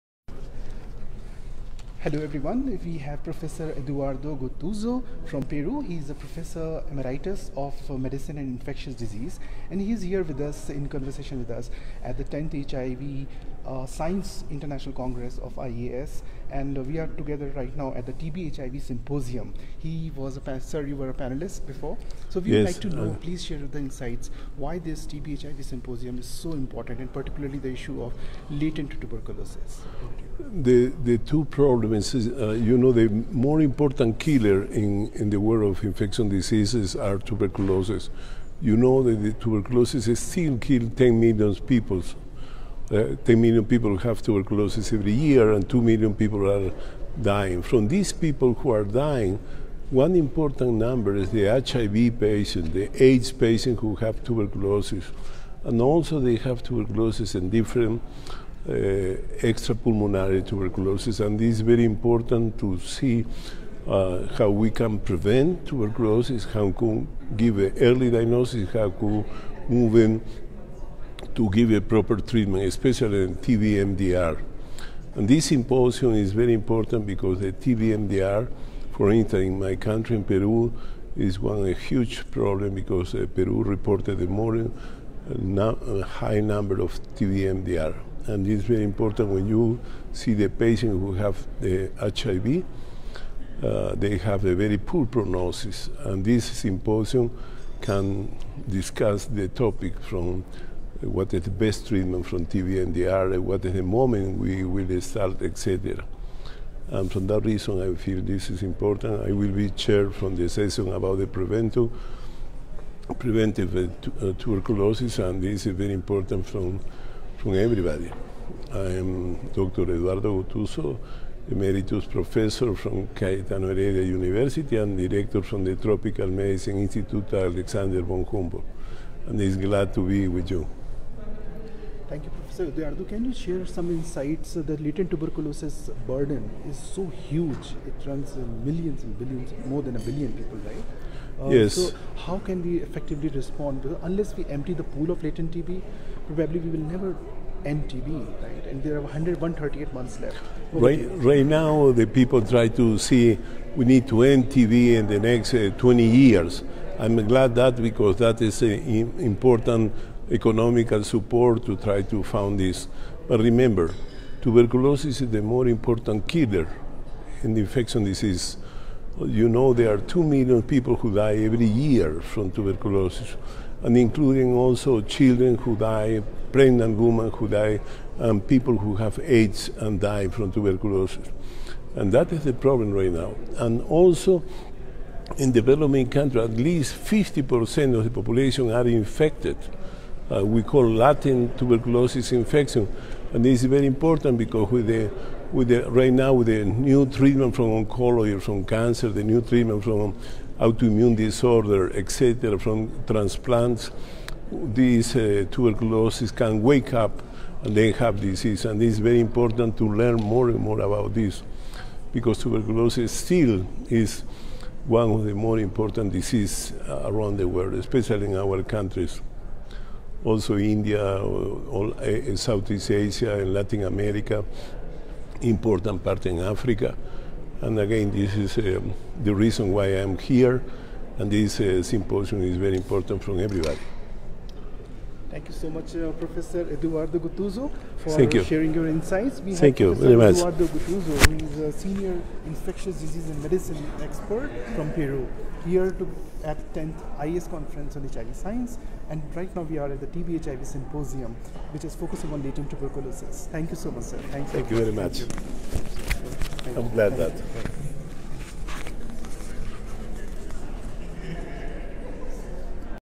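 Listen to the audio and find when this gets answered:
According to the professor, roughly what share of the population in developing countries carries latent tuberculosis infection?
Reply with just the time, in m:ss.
3:06.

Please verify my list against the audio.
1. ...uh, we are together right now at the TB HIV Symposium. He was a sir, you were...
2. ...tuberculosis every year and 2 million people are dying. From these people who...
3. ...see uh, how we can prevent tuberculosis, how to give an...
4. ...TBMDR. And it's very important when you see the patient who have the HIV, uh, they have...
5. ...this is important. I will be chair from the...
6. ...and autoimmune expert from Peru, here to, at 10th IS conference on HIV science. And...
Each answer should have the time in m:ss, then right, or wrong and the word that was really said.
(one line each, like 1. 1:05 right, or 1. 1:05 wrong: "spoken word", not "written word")
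1. 0:16 right
2. 0:44 right
3. 1:02 right
4. 1:27 right
5. 1:48 right
6. 4:03 wrong: "medicine", not "autoimmune".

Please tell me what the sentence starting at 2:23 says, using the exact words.
Because unless we empty the pool of latent TB, probably we will never end TB, right?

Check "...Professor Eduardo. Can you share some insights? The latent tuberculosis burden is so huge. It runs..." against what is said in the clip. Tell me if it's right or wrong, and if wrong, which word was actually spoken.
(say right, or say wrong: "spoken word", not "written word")
right.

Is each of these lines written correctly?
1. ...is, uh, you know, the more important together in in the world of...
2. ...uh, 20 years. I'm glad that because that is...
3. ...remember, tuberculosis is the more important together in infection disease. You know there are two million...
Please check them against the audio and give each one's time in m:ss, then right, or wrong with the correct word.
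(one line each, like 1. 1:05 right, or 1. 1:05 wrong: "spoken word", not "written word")
1. 0:32 wrong: "killer", not "together"
2. 2:35 right
3. 2:43 wrong: "killer", not "together".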